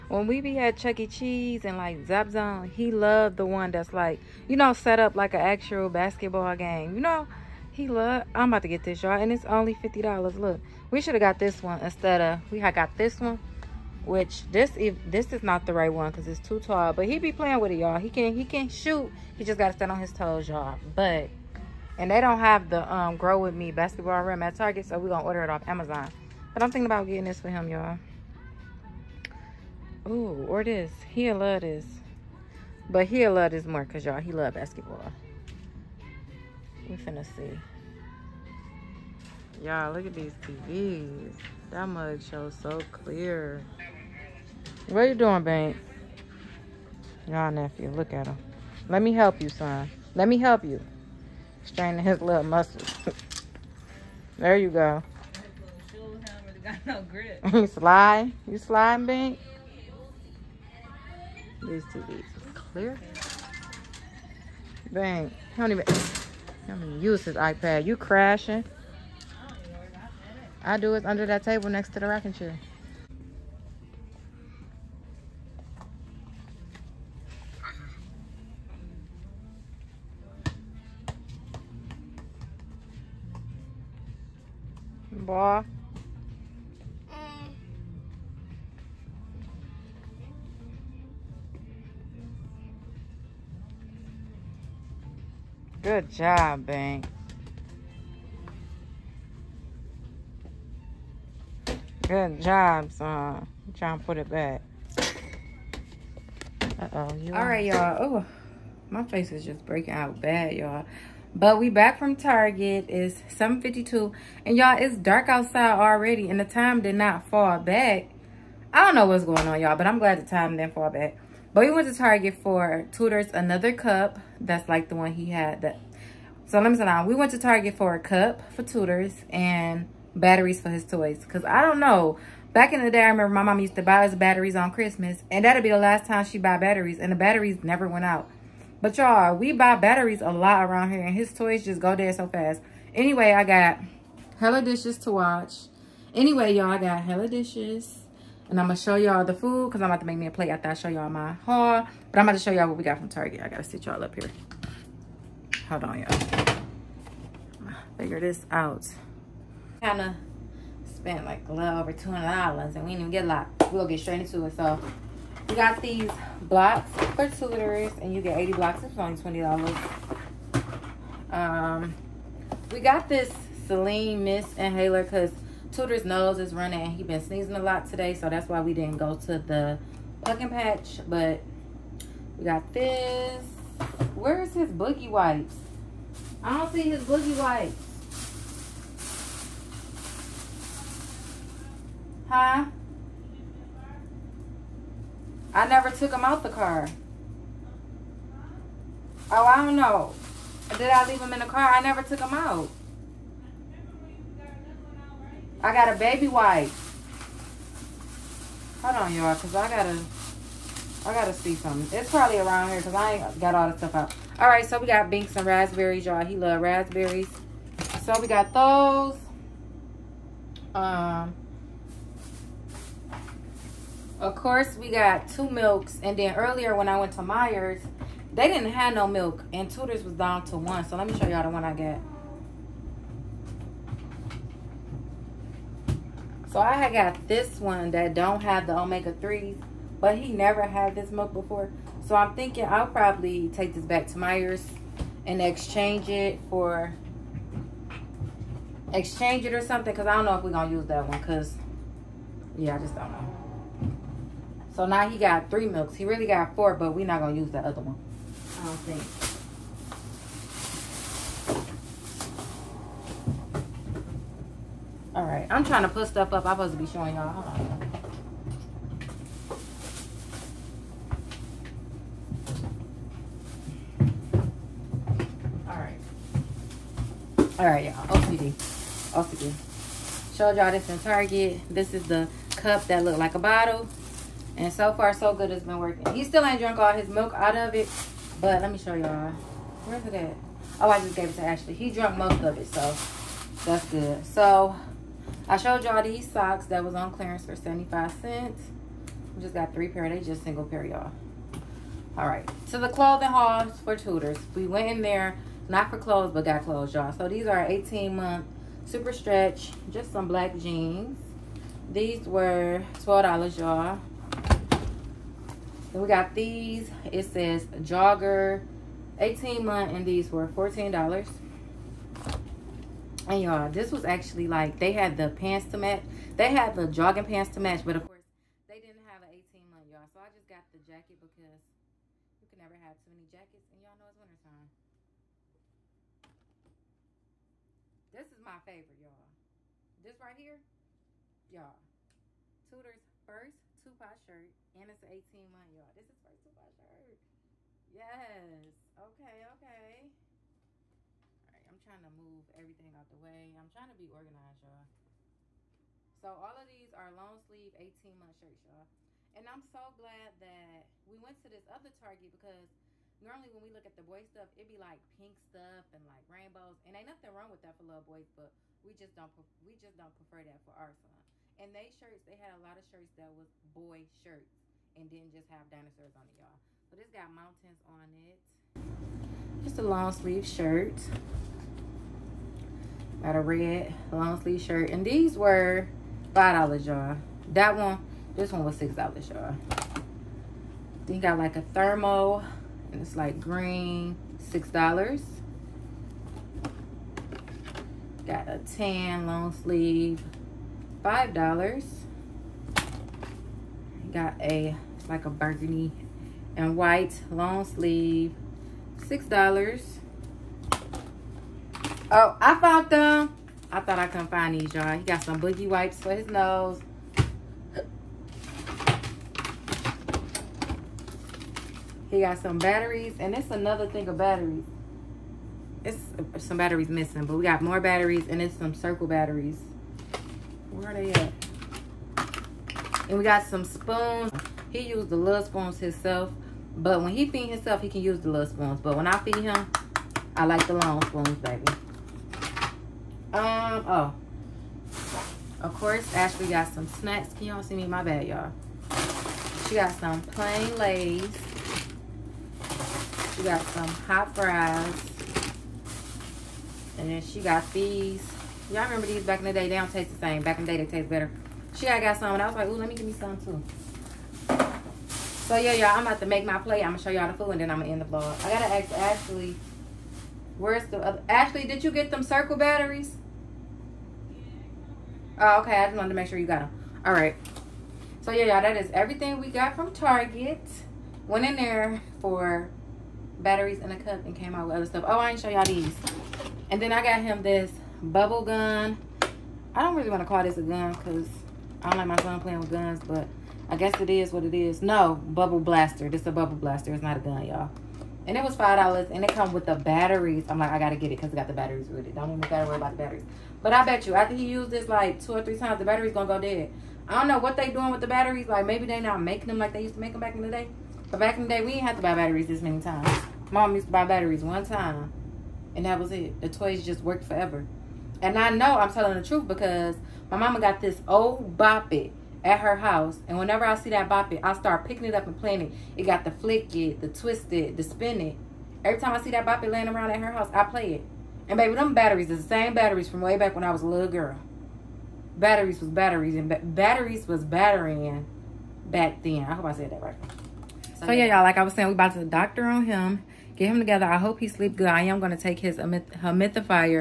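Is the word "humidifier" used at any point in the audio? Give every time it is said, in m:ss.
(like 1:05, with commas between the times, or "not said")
9:05.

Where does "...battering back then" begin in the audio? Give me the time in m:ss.
8:57.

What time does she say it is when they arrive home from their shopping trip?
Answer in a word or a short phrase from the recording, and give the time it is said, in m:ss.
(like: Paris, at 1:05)
7:52, at 1:53.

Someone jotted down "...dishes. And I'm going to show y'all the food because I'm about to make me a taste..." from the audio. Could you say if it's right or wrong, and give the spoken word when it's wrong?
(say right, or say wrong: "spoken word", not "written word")
wrong: "plate", not "taste".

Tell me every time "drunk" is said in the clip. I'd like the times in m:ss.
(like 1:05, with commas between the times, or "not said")
4:46, 4:51.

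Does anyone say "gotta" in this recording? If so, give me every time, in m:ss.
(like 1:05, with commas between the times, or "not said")
3:31, 8:22.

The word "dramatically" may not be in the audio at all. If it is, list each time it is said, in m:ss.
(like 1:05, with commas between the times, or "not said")
not said.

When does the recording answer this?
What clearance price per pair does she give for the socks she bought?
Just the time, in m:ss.
4:57.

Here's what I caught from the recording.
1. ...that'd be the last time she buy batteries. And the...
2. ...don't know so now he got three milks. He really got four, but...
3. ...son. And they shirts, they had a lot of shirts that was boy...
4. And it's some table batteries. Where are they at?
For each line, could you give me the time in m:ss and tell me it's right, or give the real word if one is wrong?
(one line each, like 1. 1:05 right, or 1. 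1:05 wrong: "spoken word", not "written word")
1. 2:15 right
2. 4:12 right
3. 6:10 right
4. 7:08 wrong: "circle", not "table".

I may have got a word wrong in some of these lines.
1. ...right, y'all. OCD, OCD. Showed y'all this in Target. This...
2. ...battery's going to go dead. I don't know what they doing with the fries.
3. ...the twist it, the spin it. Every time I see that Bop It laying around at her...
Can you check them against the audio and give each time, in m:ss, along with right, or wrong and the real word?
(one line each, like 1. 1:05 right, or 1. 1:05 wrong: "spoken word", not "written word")
1. 4:37 right
2. 8:25 wrong: "batteries", not "fries"
3. 8:47 right.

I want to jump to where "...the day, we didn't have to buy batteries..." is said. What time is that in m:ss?
8:31.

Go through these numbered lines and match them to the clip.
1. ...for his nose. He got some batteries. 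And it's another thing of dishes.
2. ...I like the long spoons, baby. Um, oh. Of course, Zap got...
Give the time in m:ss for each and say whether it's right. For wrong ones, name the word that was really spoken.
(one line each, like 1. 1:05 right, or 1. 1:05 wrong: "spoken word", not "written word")
1. 6:55 wrong: "batteries", not "dishes"
2. 7:20 wrong: "Ashley", not "Zap".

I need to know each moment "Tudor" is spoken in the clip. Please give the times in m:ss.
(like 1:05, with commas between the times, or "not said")
2:55, 3:49, 5:42.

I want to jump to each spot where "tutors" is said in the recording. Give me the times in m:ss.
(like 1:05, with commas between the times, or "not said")
2:02, 2:08, 5:03.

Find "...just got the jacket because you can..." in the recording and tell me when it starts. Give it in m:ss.
5:30.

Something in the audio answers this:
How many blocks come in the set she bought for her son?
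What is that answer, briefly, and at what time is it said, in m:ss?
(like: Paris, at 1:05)
80, at 2:48.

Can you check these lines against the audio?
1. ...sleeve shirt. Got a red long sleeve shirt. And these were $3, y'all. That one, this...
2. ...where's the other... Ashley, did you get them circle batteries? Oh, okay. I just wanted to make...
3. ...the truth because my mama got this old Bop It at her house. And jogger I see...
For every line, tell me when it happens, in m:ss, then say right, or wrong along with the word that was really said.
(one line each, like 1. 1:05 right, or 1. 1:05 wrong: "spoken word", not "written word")
1. 6:20 wrong: "5", not "3"
2. 7:50 right
3. 8:39 wrong: "whenever", not "jogger".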